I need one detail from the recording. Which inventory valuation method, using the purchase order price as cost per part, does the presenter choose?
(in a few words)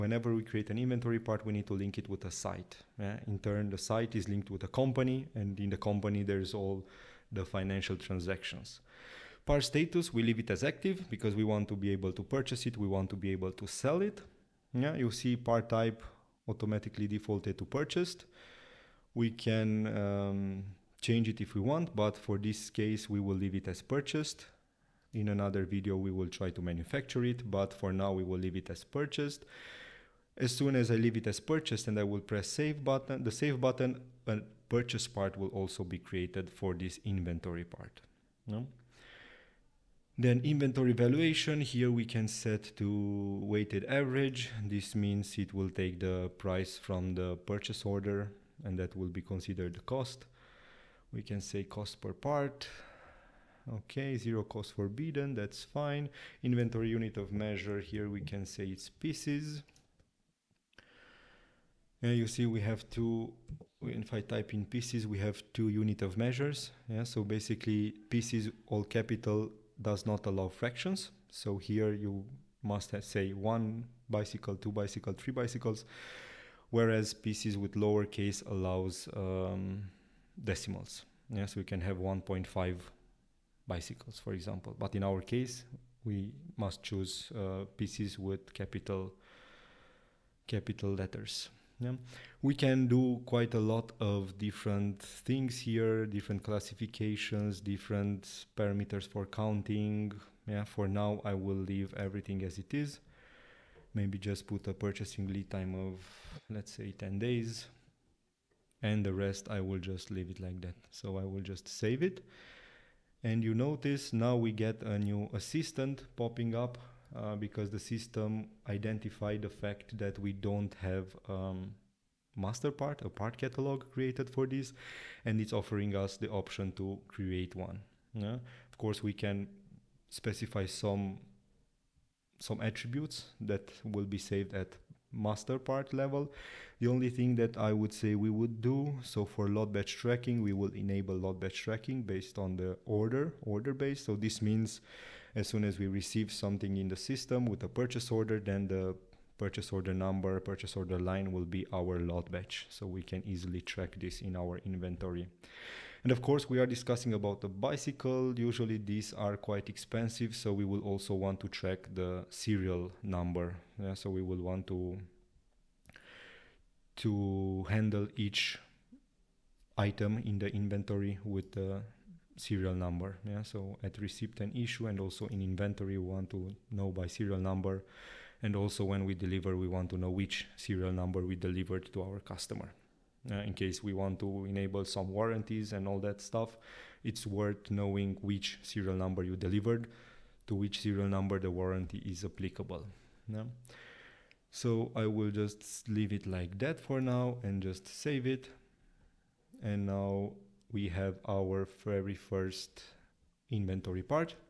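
Weighted average.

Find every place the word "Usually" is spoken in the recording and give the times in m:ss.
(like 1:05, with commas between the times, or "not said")
2:38.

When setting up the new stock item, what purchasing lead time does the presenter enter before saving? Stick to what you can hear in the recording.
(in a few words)
10 days.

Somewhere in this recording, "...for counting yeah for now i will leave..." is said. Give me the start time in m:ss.
1:39.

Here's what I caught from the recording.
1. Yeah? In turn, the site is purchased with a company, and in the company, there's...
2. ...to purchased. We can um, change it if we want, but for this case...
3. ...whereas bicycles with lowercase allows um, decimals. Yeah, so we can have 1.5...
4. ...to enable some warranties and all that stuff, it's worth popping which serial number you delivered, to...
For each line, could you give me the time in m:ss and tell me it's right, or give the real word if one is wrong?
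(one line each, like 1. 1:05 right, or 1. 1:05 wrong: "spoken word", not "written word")
1. 0:02 wrong: "linked", not "purchased"
2. 0:17 right
3. 1:16 wrong: "pieces", not "bicycles"
4. 3:04 wrong: "knowing", not "popping".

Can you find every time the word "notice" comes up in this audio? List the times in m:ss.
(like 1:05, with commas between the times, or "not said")
1:53.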